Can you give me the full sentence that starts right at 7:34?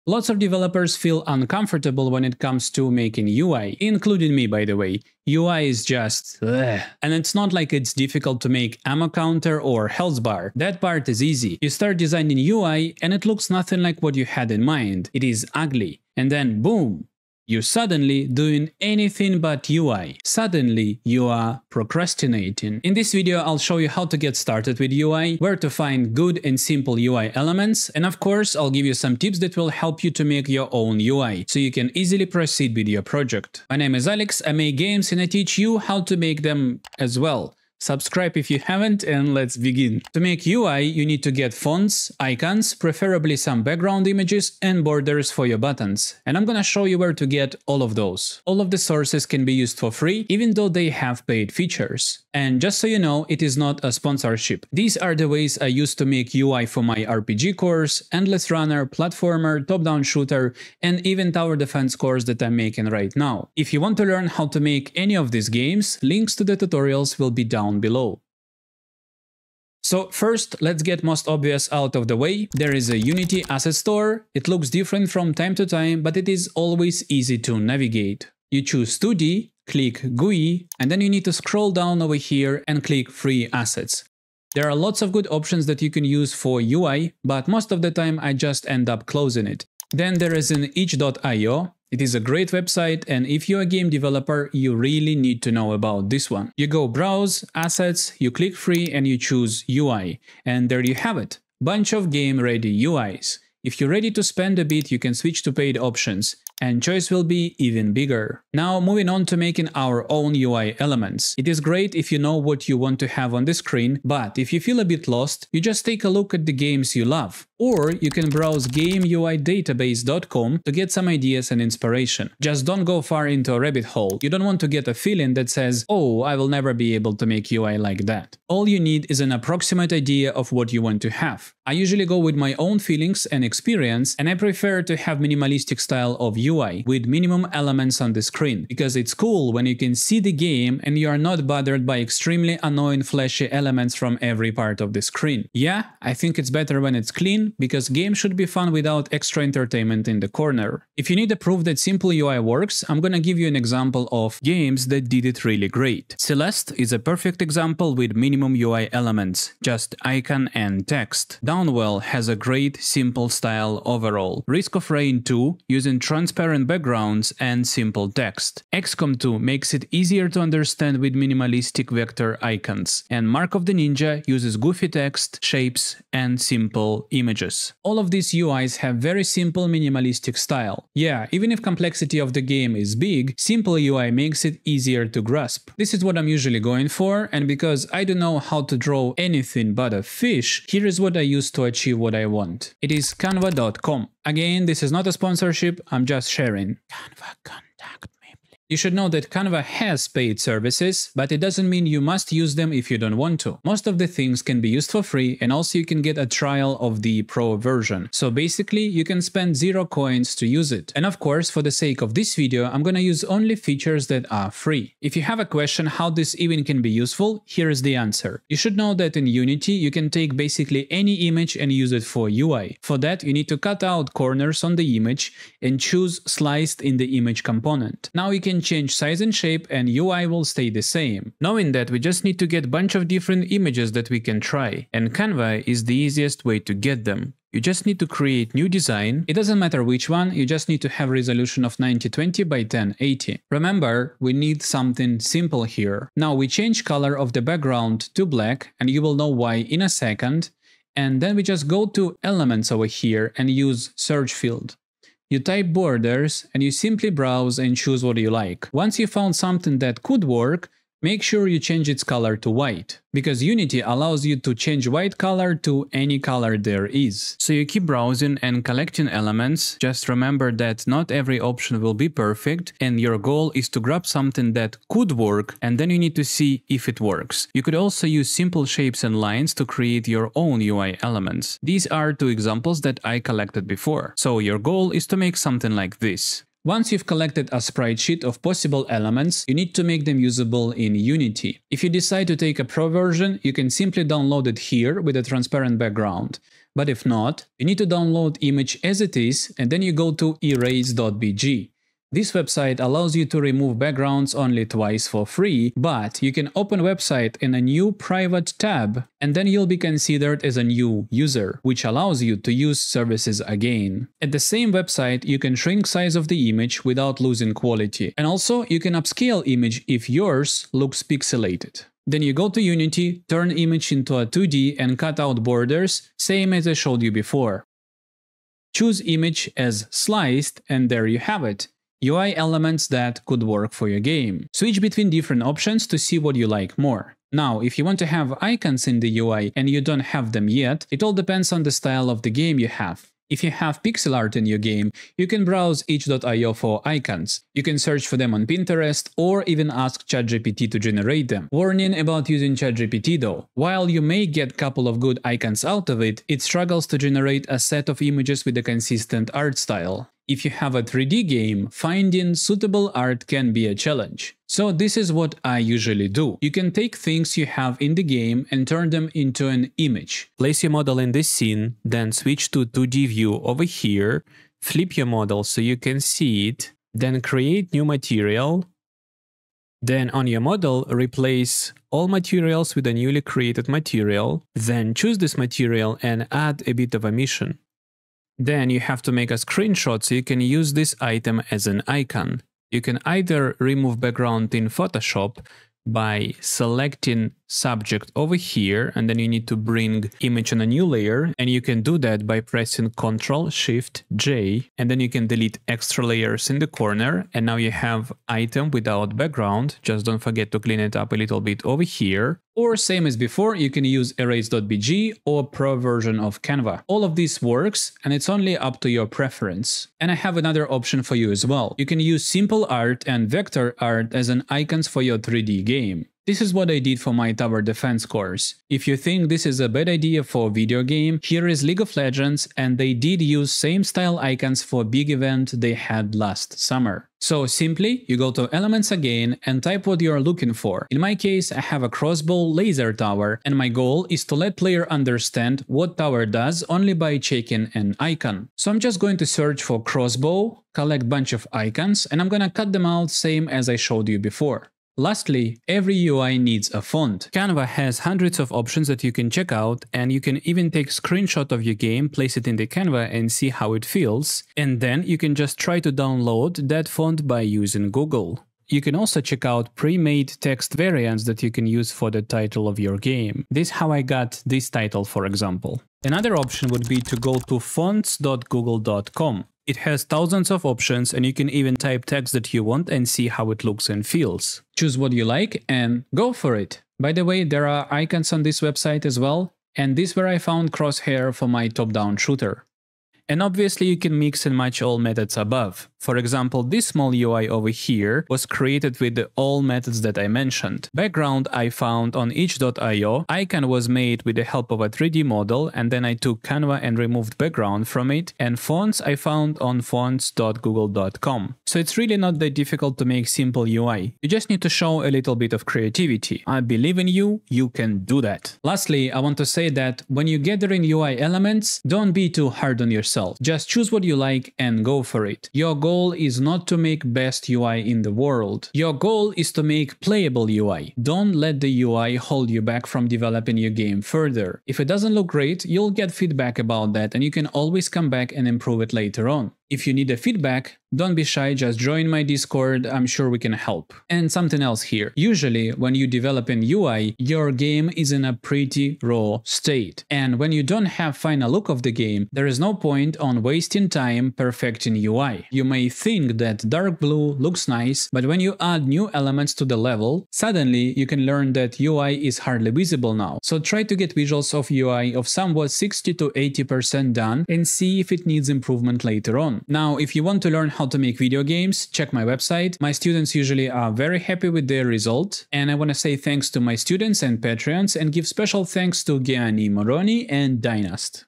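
Lastly, every UI needs a font.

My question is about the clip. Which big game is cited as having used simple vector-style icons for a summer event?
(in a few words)
League of Legends.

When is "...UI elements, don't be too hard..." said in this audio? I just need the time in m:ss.
8:40.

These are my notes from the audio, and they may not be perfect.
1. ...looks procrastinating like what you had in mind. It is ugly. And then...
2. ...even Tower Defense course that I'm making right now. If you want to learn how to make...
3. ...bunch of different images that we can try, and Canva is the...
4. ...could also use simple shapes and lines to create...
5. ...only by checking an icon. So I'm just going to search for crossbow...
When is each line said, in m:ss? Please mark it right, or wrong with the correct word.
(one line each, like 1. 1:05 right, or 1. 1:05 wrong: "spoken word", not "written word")
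1. 0:13 wrong: "nothing", not "procrastinating"
2. 1:01 right
3. 3:52 right
4. 4:37 right
5. 7:26 right.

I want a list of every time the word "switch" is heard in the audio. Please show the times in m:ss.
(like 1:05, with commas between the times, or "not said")
1:45, 5:34, 6:12.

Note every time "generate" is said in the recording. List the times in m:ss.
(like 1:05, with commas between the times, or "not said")
5:50, 5:56.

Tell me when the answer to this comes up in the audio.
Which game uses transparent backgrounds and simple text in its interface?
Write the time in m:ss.
2:44.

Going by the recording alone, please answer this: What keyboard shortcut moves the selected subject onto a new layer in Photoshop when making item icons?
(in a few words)
Ctrl Shift J.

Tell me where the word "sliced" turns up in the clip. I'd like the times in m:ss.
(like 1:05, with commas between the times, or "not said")
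3:46, 5:29.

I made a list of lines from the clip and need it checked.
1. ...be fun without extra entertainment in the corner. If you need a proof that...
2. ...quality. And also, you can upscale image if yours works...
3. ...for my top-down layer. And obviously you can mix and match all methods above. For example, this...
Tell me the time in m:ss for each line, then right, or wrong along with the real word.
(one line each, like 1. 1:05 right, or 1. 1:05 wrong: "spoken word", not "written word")
1. 2:28 right
2. 5:17 wrong: "looks", not "works"
3. 8:11 wrong: "shooter", not "layer".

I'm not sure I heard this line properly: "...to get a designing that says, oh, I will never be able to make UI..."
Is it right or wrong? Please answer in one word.
wrong.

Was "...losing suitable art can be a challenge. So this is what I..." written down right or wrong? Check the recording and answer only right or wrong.
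wrong.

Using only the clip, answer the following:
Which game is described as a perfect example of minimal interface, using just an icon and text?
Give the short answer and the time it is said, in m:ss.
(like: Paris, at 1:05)
Celeste, at 2:36.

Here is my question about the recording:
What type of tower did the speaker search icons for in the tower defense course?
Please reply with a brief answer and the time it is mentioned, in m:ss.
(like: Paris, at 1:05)
crossbow laser tower, at 7:21.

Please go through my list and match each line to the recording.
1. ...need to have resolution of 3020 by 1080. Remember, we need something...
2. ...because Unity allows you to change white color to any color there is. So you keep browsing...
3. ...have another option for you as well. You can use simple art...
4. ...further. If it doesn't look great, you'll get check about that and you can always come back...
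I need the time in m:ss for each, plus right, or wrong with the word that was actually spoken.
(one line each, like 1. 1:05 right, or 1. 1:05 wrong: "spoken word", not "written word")
1. 4:00 wrong: "9020", not "3020"
2. 4:23 right
3. 7:00 right
4. 8:54 wrong: "feedback", not "check".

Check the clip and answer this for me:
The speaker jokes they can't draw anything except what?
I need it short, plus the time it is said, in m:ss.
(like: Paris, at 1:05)
a fish, at 3:09.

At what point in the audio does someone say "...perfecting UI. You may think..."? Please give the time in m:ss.
9:14.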